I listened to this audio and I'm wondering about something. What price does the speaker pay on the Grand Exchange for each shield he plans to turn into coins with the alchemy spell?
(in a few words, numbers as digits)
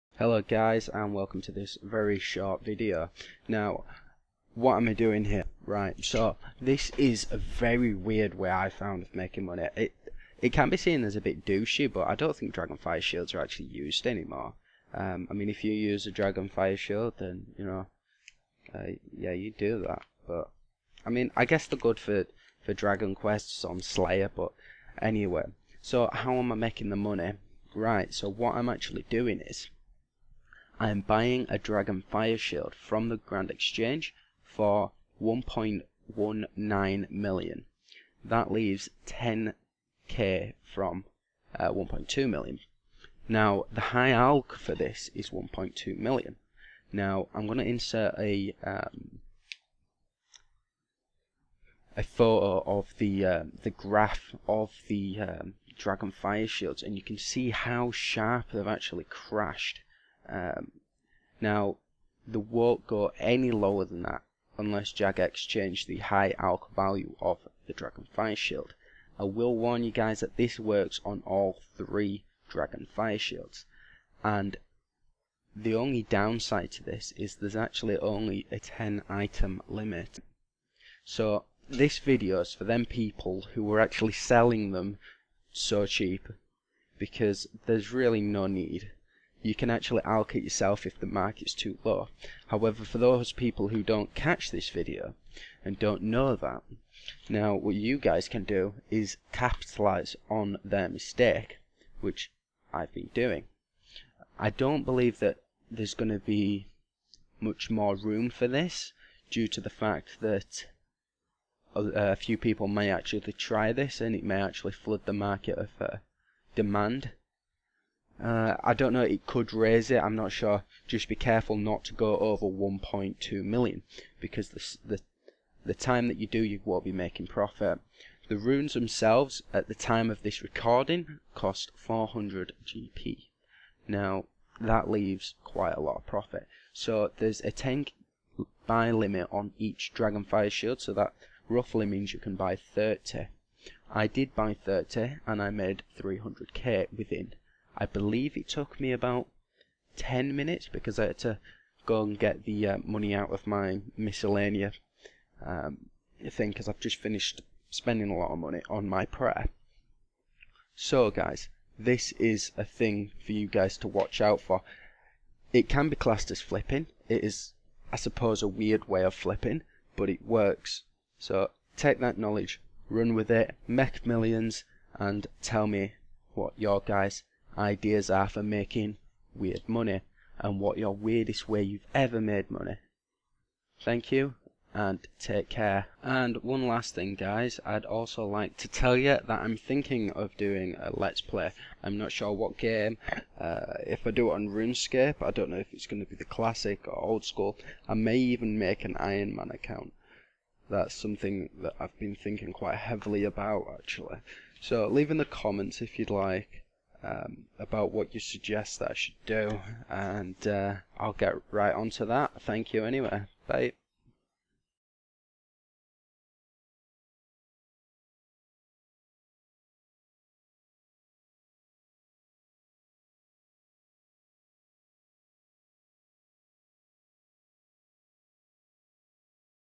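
1.19 million.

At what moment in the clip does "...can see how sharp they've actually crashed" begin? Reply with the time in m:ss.
0:57.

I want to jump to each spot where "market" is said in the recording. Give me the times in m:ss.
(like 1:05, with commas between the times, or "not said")
1:31, 1:55.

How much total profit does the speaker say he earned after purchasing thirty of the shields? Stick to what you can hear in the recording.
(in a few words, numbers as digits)
300k.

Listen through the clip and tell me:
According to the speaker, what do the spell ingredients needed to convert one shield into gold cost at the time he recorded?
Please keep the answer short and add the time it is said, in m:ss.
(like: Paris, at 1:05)
400 GP, at 2:11.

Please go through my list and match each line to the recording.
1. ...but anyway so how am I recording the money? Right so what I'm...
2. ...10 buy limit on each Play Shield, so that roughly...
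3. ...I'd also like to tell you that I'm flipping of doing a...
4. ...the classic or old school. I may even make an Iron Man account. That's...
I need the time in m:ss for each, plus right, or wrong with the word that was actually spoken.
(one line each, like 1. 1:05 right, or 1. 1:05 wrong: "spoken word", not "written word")
1. 0:24 wrong: "making", not "recording"
2. 2:17 wrong: "Dragonfire", not "Play"
3. 3:07 wrong: "thinking", not "flipping"
4. 3:16 right.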